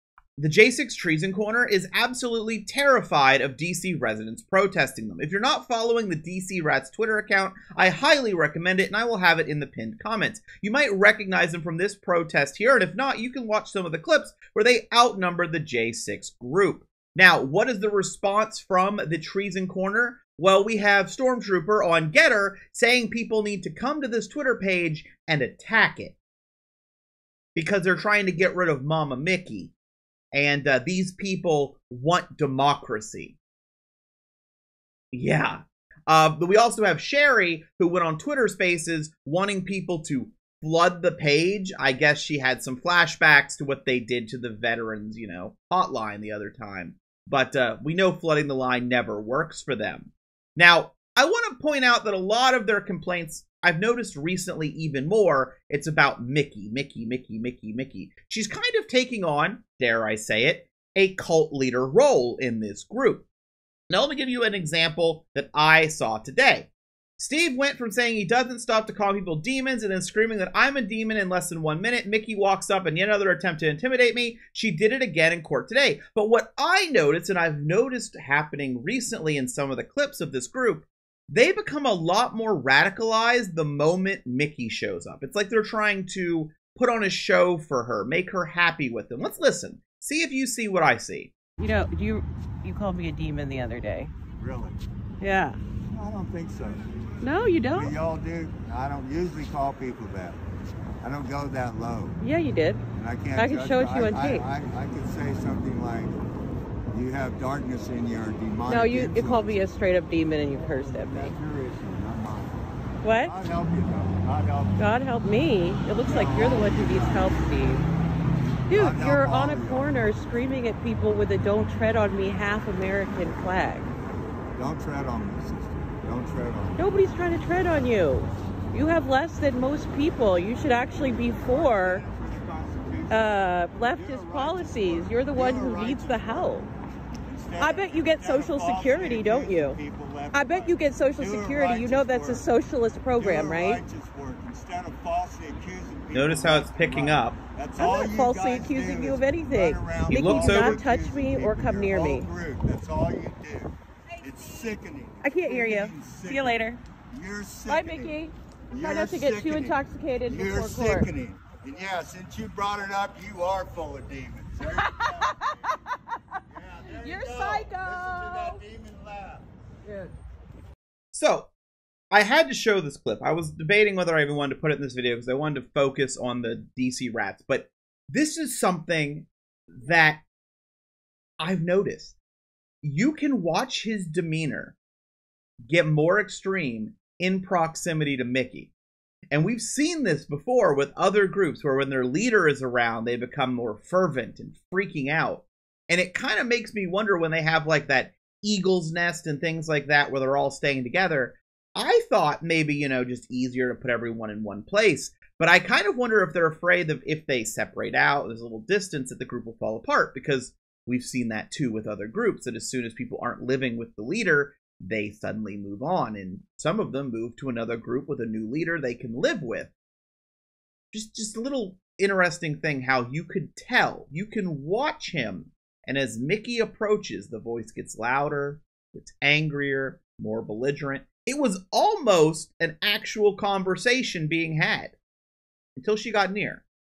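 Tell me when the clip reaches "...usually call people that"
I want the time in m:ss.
1:39.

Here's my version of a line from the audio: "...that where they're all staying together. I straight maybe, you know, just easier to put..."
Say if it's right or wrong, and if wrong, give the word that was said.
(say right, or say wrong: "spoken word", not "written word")
wrong: "thought", not "straight".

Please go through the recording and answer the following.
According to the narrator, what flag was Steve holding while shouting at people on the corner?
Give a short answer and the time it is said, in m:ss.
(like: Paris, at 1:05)
Don't tread on me half American flag, at 2:01.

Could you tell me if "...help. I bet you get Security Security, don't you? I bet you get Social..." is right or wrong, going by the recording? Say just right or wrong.
wrong.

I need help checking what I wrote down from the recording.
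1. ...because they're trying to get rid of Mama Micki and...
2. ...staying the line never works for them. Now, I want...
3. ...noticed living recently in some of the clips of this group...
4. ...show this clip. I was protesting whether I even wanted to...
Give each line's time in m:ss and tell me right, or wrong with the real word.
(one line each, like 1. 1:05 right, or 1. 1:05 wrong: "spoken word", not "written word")
1. 0:27 right
2. 0:48 wrong: "flooding", not "staying"
3. 1:17 wrong: "happening", not "living"
4. 2:52 wrong: "debating", not "protesting".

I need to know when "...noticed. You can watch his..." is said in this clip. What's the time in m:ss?
3:01.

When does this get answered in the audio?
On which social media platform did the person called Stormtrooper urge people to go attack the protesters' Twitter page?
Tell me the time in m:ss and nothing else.
0:22.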